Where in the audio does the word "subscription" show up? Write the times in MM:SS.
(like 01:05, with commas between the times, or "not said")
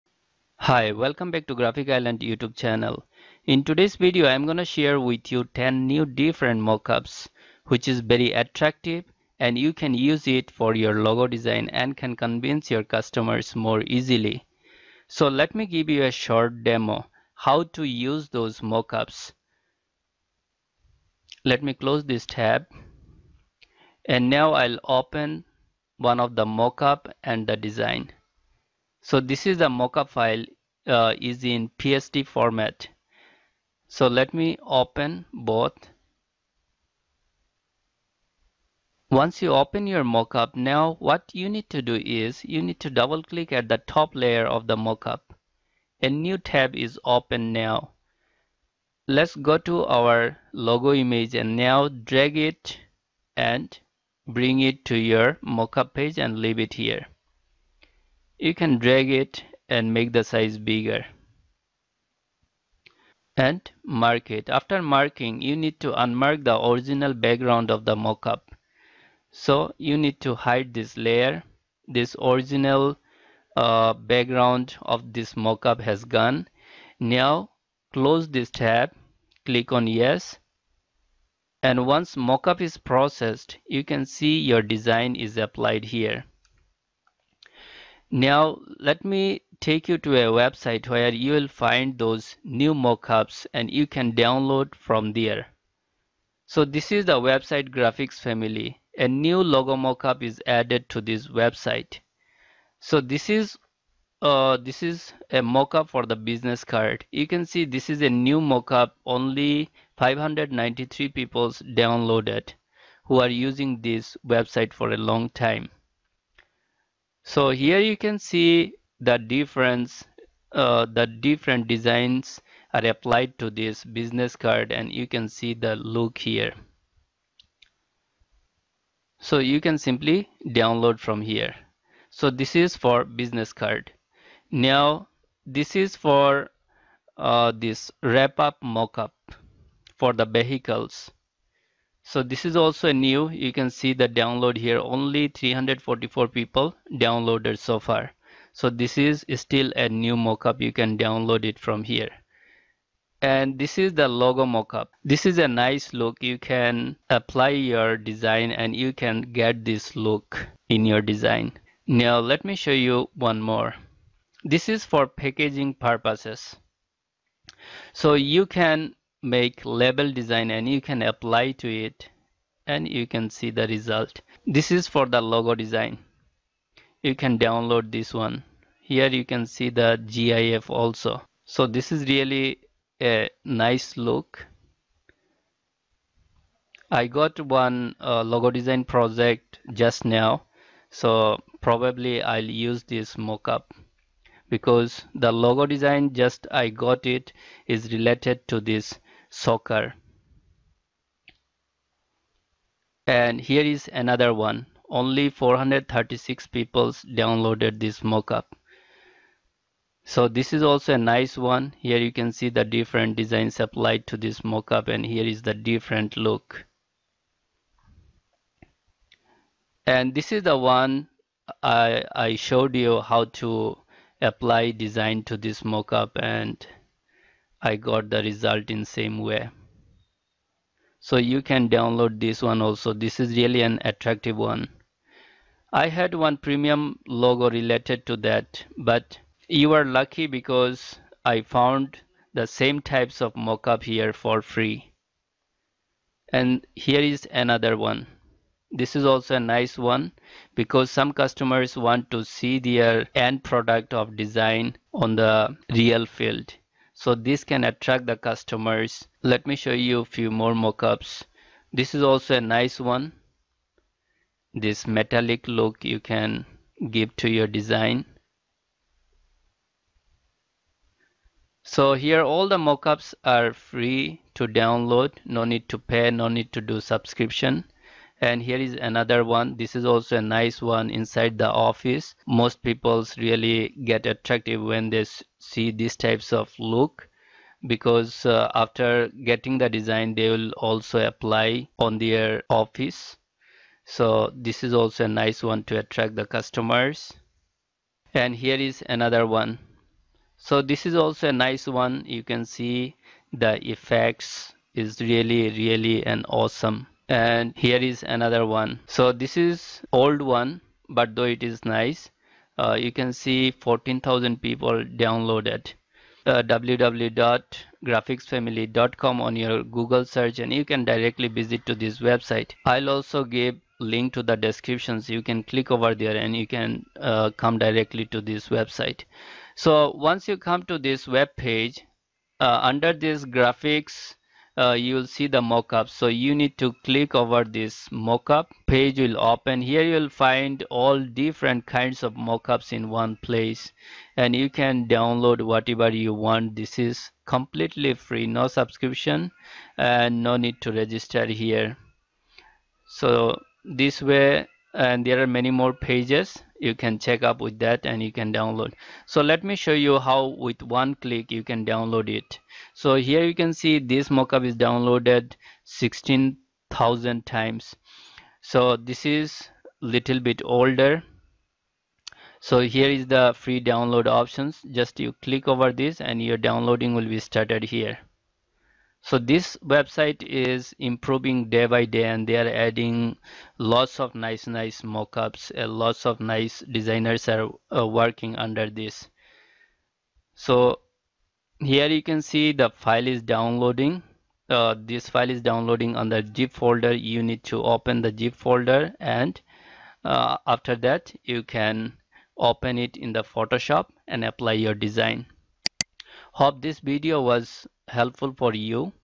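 04:36, 05:48.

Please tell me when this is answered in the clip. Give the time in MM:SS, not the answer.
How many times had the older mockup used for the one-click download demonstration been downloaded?
06:05.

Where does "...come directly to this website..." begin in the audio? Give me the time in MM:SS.
05:27.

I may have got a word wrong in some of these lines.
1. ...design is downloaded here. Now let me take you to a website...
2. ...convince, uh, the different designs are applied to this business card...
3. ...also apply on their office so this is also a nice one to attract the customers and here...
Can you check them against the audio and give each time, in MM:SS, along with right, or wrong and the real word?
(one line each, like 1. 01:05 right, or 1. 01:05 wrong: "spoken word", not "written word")
1. 01:24 wrong: "applied", not "downloaded"
2. 01:59 wrong: "difference", not "convince"
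3. 04:50 right.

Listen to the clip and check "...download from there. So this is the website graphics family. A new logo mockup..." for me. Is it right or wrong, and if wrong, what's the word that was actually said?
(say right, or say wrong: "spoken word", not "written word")
right.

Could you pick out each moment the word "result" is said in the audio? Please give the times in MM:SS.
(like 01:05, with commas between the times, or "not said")
02:53, 03:48.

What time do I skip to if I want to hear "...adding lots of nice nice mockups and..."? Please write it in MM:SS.
06:22.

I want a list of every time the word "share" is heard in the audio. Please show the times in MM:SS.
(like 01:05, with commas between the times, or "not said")
00:04.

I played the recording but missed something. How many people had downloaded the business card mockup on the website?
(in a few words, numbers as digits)
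593.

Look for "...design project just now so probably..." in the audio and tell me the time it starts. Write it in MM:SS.
03:08.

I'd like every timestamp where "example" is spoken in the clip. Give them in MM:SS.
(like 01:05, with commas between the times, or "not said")
not said.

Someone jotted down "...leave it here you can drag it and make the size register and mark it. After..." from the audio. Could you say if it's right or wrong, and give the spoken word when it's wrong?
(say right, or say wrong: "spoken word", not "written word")
wrong: "bigger", not "register".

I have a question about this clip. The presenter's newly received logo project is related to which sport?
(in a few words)
Soccer.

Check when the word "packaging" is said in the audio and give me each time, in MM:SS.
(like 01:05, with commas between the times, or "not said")
02:45.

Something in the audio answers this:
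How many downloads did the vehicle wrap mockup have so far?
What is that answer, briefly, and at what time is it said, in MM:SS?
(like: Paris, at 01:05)
344, at 02:25.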